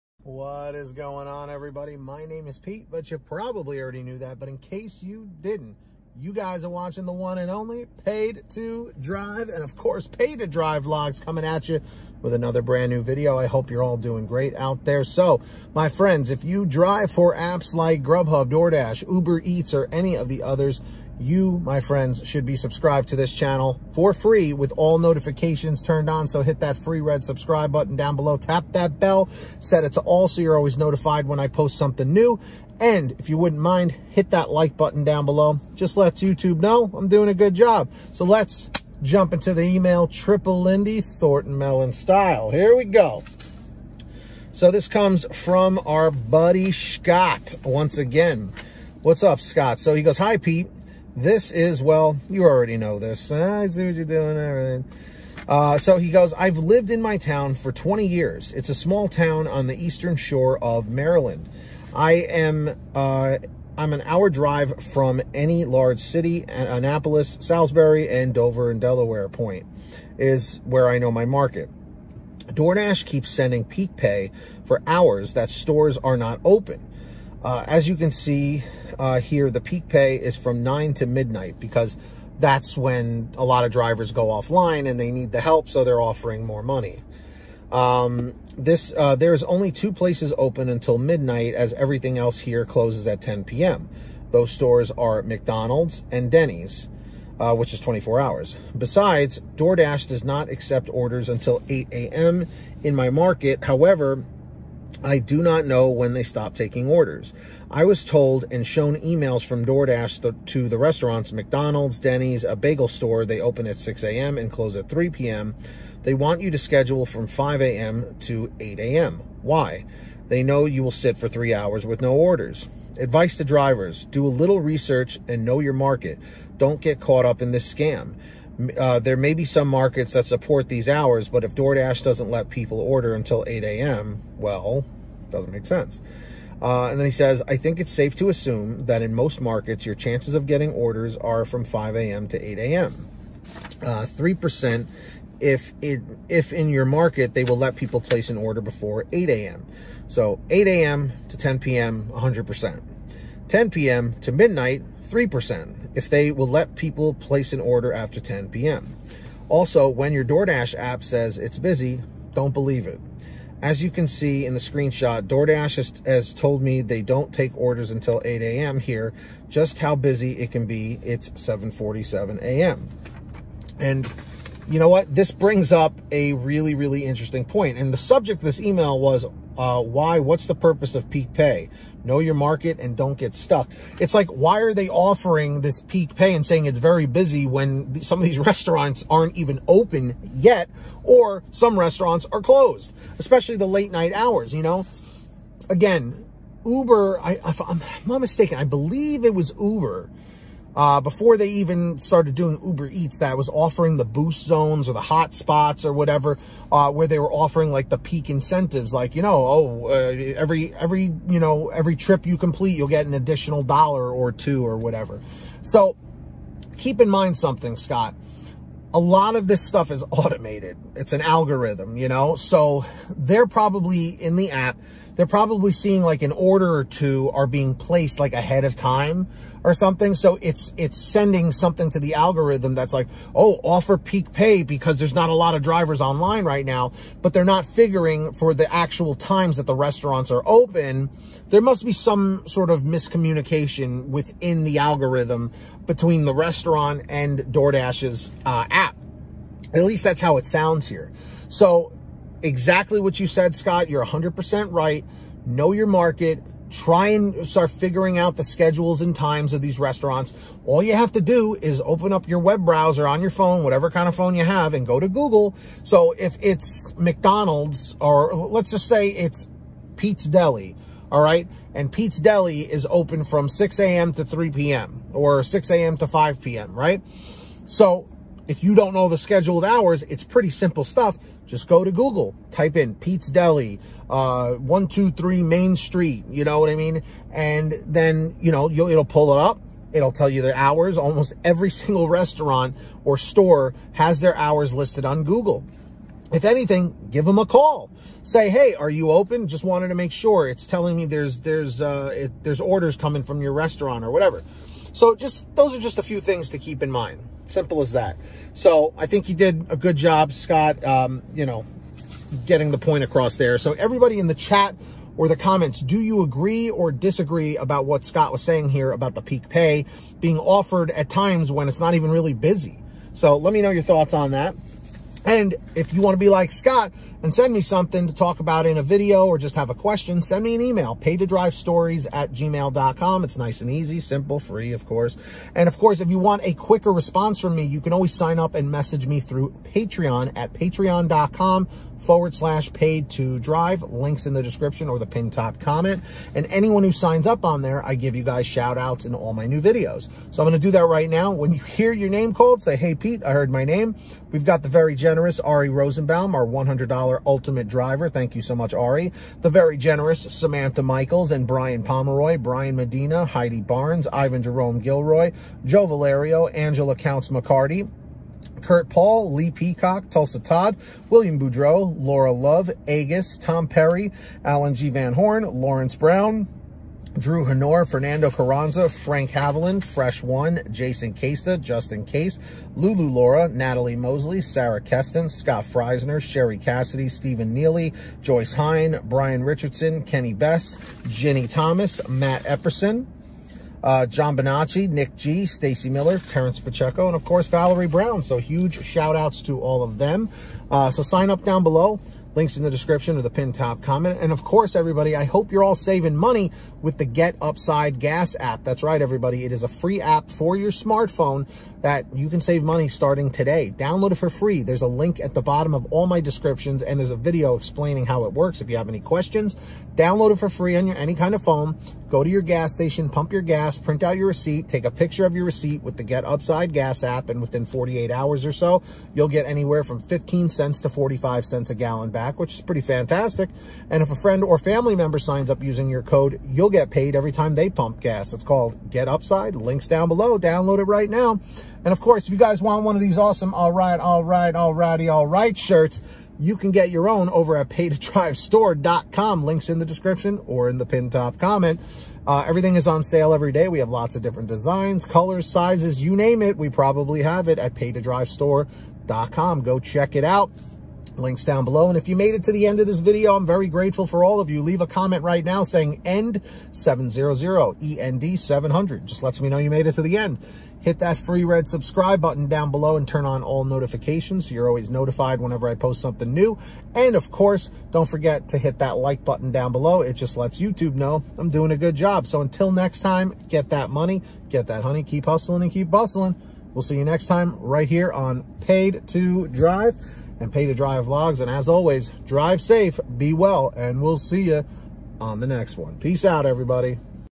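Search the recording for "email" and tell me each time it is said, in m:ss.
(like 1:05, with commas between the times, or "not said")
0:39, 1:48, 2:58, 5:30.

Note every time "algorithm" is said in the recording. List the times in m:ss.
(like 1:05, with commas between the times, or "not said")
3:41, 3:52, 4:04.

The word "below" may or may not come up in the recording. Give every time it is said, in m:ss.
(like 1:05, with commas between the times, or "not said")
0:28, 0:35, 6:41, 7:20, 7:41, 7:52, 7:59.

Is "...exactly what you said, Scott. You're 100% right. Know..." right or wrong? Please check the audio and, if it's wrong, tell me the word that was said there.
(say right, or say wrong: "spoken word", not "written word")
right.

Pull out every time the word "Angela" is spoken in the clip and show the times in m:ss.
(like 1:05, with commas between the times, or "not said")
6:06.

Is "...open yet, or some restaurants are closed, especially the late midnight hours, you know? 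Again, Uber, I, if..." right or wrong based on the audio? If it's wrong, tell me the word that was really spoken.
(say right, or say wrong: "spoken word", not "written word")
wrong: "night", not "midnight".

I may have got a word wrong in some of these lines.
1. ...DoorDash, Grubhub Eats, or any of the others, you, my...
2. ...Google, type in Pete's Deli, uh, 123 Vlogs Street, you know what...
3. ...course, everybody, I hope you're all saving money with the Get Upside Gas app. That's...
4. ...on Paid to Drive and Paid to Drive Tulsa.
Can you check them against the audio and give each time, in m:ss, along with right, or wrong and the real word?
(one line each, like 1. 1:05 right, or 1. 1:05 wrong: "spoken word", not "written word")
1. 0:18 wrong: "Uber", not "Grubhub"
2. 4:41 wrong: "Main", not "Vlogs"
3. 6:44 right
4. 8:08 wrong: "Vlogs", not "Tulsa".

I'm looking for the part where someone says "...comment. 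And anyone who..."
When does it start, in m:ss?
5:45.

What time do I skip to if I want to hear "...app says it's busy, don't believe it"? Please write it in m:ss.
2:40.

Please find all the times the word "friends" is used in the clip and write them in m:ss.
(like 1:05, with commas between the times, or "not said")
0:15, 0:21, 7:14.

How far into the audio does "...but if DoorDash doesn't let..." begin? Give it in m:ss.
2:11.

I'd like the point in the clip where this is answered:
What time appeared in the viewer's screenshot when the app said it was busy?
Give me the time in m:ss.
2:51.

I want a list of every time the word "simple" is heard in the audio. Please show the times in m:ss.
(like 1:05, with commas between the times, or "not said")
4:40, 5:07, 5:33.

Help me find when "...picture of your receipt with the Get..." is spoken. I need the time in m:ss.
7:04.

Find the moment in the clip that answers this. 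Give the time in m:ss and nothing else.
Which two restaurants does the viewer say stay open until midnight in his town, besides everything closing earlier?
1:35.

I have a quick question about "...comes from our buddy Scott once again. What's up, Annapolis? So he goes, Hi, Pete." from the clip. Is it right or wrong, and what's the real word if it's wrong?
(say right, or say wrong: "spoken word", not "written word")
wrong: "Scott", not "Annapolis".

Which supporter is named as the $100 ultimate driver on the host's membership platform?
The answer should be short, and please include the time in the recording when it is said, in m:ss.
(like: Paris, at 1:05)
Ari Rosenbaum, at 5:55.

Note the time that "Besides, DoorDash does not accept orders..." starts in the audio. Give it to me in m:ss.
1:38.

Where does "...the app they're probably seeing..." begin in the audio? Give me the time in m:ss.
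3:44.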